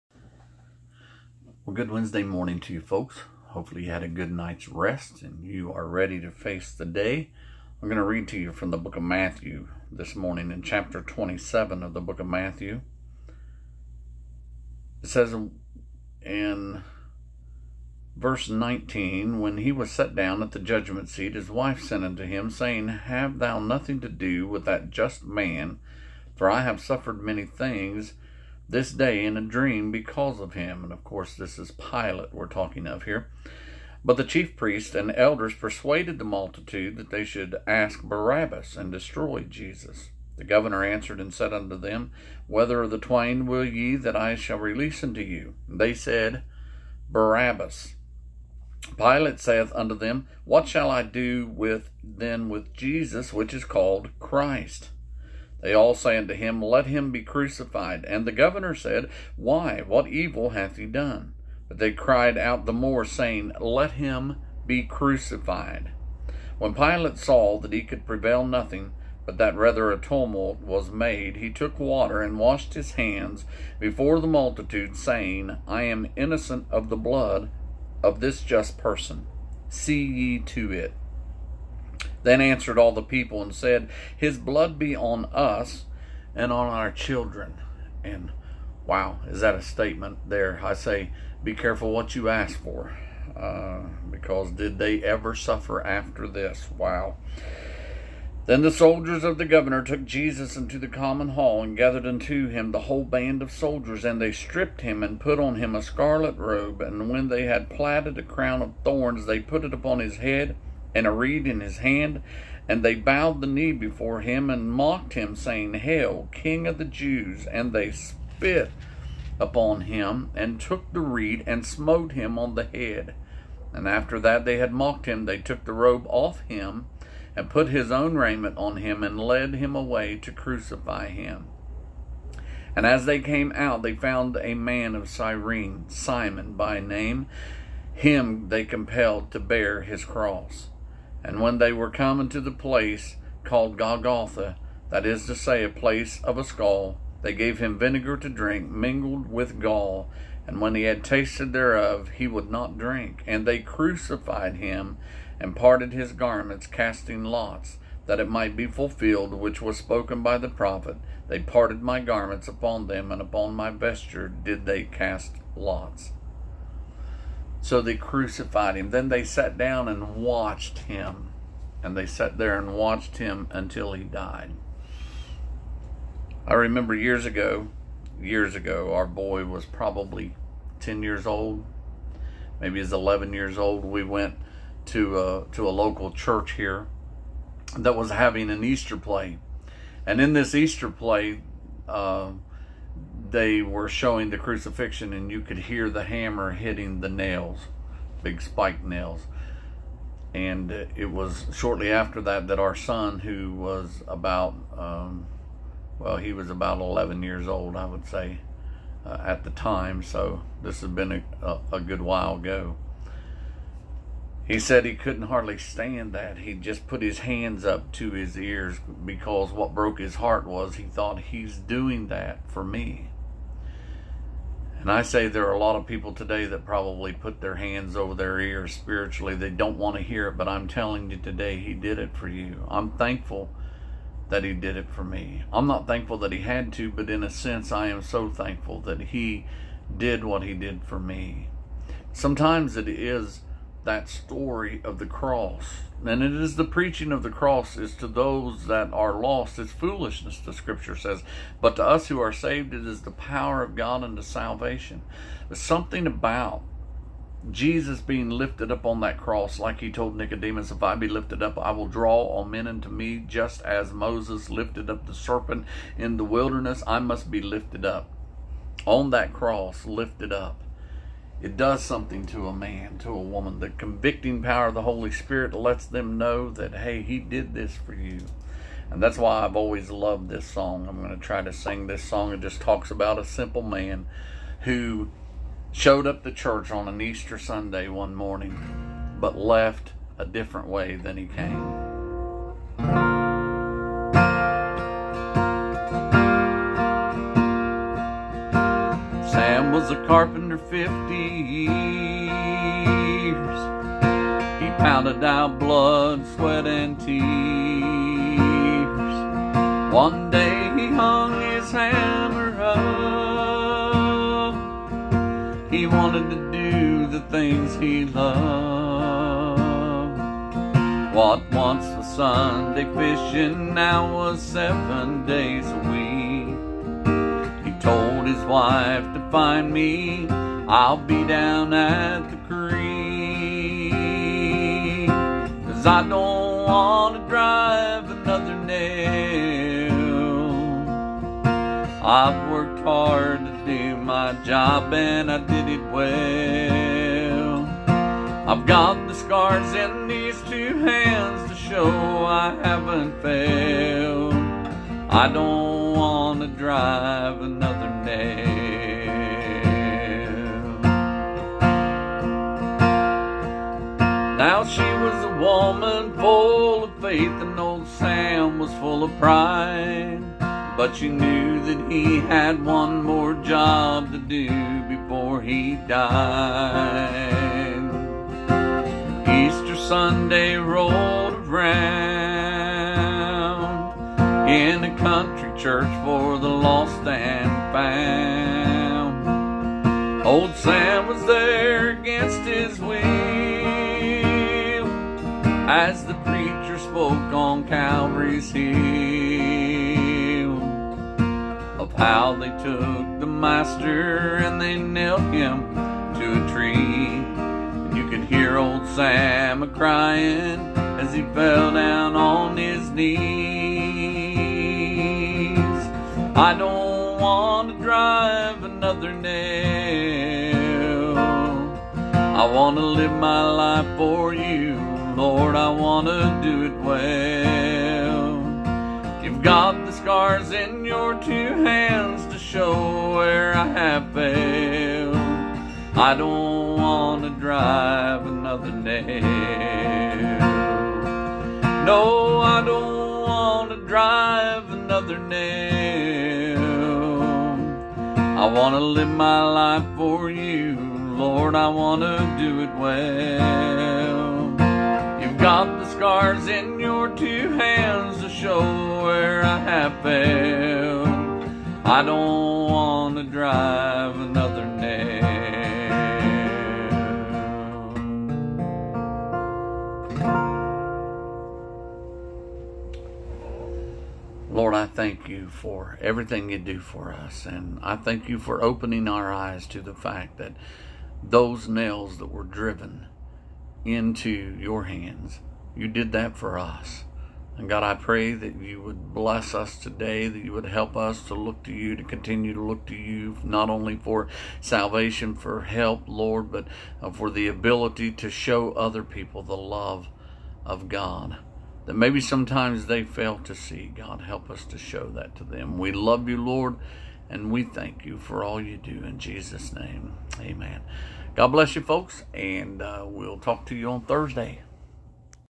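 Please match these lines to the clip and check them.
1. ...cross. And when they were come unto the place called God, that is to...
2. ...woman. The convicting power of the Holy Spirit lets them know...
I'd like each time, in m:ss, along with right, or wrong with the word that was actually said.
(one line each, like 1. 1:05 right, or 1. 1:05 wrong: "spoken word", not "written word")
1. 2:20 wrong: "Golgotha", not "God"
2. 4:33 right.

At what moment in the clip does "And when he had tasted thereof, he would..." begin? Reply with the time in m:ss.
2:30.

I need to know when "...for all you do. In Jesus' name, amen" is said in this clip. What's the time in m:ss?
8:28.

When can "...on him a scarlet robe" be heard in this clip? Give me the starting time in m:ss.
1:45.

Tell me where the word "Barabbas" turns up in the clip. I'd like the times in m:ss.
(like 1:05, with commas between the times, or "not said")
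0:38, 0:47.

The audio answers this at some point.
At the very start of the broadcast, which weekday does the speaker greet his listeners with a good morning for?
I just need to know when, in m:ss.
0:01.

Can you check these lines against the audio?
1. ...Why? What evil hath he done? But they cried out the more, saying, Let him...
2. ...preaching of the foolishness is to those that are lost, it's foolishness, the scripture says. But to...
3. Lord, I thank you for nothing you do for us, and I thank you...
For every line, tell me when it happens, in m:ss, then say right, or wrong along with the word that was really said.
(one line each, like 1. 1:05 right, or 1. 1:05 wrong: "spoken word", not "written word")
1. 0:59 right
2. 4:06 wrong: "cross", not "foolishness"
3. 7:54 wrong: "everything", not "nothing".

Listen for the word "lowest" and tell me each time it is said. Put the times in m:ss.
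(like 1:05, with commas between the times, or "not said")
not said.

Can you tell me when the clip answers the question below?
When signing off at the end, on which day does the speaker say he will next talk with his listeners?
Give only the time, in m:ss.
8:34.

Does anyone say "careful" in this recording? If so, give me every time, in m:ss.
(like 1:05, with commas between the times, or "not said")
1:31.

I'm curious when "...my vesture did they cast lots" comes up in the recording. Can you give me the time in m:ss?
2:43.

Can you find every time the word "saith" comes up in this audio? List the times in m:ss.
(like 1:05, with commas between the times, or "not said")
0:49.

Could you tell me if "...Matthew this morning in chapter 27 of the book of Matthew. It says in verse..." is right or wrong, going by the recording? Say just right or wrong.
right.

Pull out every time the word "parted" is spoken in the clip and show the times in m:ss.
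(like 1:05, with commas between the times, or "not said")
2:35, 2:41.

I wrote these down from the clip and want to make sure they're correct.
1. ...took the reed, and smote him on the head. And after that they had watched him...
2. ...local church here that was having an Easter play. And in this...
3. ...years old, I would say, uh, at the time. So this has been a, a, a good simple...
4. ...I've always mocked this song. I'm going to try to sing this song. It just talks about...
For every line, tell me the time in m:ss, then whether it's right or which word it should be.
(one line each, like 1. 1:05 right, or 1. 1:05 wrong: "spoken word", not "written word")
1. 2:00 wrong: "mocked", not "watched"
2. 3:05 right
3. 3:27 wrong: "while", not "simple"
4. 4:39 wrong: "loved", not "mocked".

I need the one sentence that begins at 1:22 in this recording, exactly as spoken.
Then answered all the people and said, His blood be on us and on our children.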